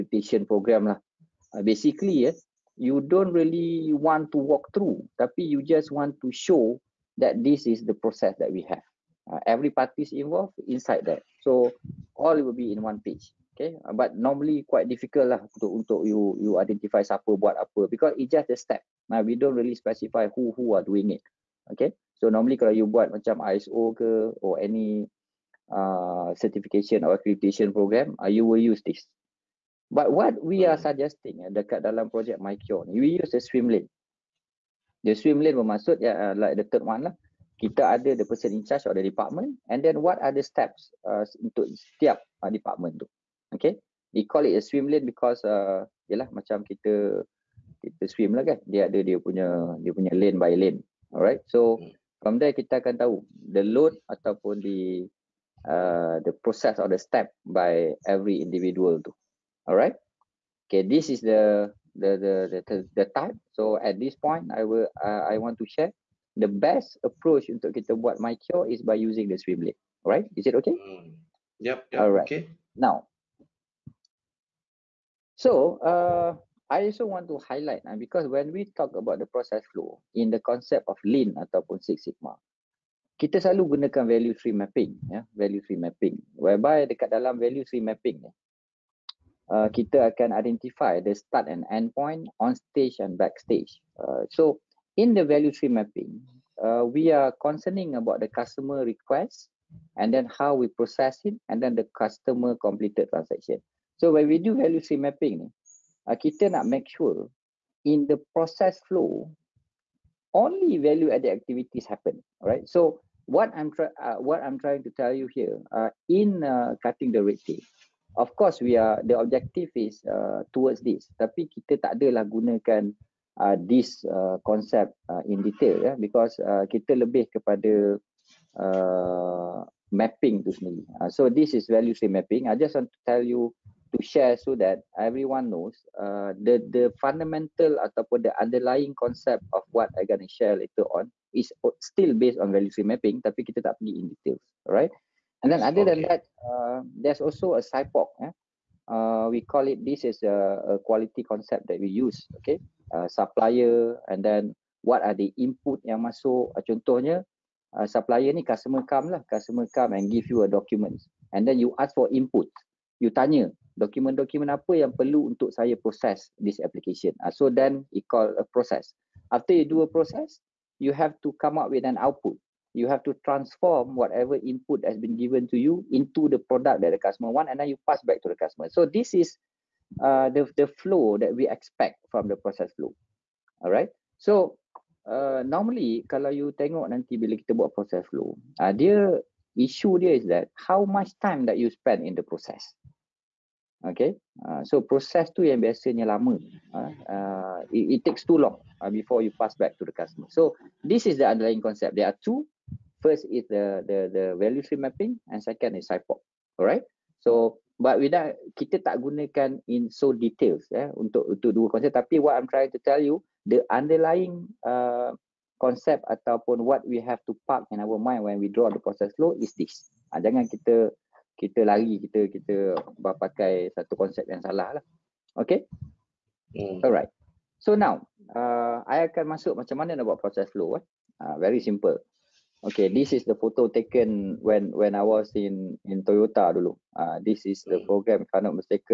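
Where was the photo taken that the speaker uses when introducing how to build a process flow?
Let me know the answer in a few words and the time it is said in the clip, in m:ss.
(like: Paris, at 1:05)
Toyota, at 3:56.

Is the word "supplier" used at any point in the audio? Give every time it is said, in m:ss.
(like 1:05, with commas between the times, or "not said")
2:33, 2:37.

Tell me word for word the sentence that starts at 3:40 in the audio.
Uh, jangan kita kita lari kita kita pakai satu konsep yang salah lah.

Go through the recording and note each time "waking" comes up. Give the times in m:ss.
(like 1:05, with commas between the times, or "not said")
not said.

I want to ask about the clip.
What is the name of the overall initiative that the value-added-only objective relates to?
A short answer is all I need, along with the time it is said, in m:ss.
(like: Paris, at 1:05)
Cutting the red tape, at 1:56.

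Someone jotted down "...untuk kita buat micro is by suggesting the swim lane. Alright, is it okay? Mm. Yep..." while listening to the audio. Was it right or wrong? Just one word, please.
wrong.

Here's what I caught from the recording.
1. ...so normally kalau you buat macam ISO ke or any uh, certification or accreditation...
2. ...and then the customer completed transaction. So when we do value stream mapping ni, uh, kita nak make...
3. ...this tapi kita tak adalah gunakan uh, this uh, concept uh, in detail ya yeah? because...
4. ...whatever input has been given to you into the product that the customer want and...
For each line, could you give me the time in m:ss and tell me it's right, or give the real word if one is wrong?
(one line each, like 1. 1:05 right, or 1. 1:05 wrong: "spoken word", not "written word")
1. 0:22 right
2. 1:41 right
3. 2:00 right
4. 2:53 right.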